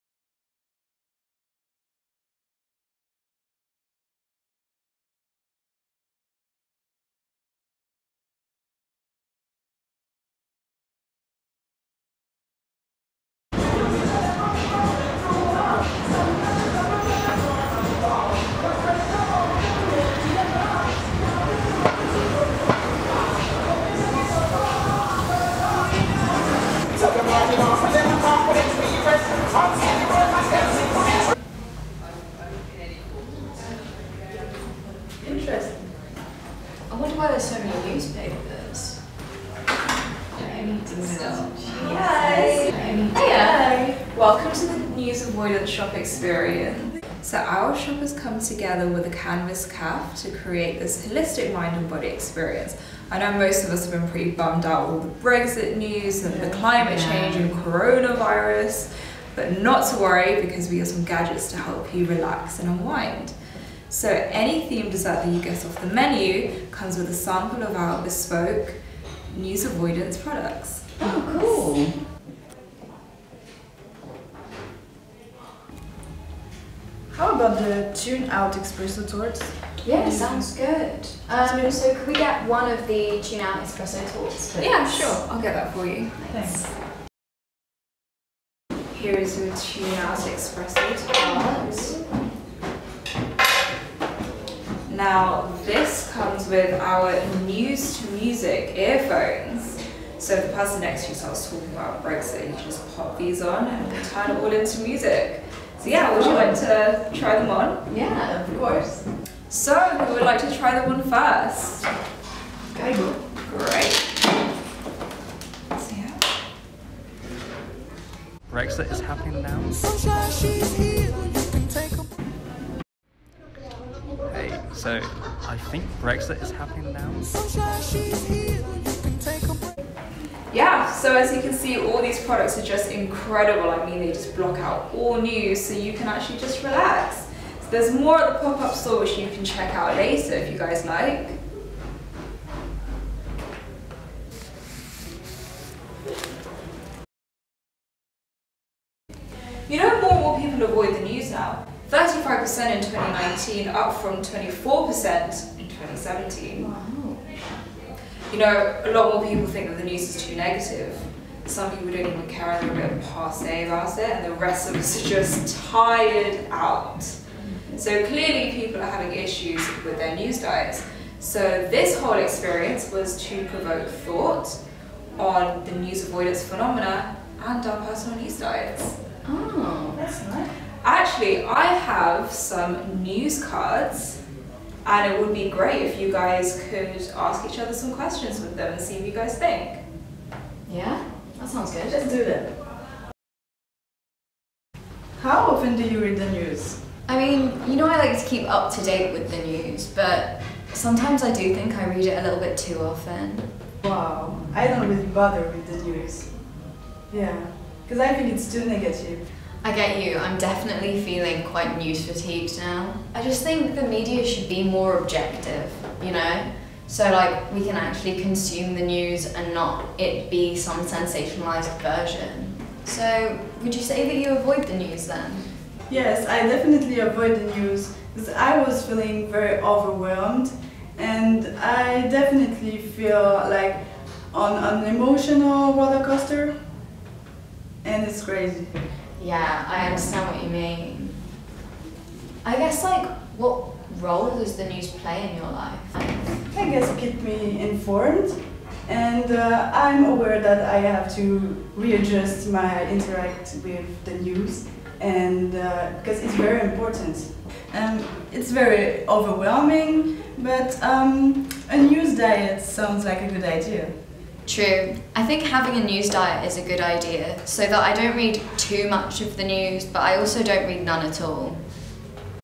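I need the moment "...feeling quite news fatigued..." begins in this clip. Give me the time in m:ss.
3:31.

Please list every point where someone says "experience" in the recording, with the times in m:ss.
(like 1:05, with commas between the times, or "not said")
0:45, 0:52, 2:52.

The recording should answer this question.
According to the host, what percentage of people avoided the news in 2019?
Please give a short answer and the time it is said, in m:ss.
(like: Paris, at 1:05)
35%, at 2:31.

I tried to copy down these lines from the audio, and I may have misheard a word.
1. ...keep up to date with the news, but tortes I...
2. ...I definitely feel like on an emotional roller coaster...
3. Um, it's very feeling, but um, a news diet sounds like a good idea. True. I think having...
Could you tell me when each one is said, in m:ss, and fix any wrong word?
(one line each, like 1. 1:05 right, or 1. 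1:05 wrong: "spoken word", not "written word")
1. 3:18 wrong: "sometimes", not "tortes"
2. 3:51 right
3. 4:17 wrong: "overwhelming", not "feeling".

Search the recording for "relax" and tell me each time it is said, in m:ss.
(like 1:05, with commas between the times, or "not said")
1:02, 2:16.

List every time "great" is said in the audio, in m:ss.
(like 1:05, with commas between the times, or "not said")
1:53, 3:05.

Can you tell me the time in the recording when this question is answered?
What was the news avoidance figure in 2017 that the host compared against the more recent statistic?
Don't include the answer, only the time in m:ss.
2:34.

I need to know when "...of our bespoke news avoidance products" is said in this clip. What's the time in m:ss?
1:07.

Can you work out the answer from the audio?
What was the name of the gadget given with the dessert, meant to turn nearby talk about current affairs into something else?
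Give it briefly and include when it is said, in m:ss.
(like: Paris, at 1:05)
News to music earphones, at 1:37.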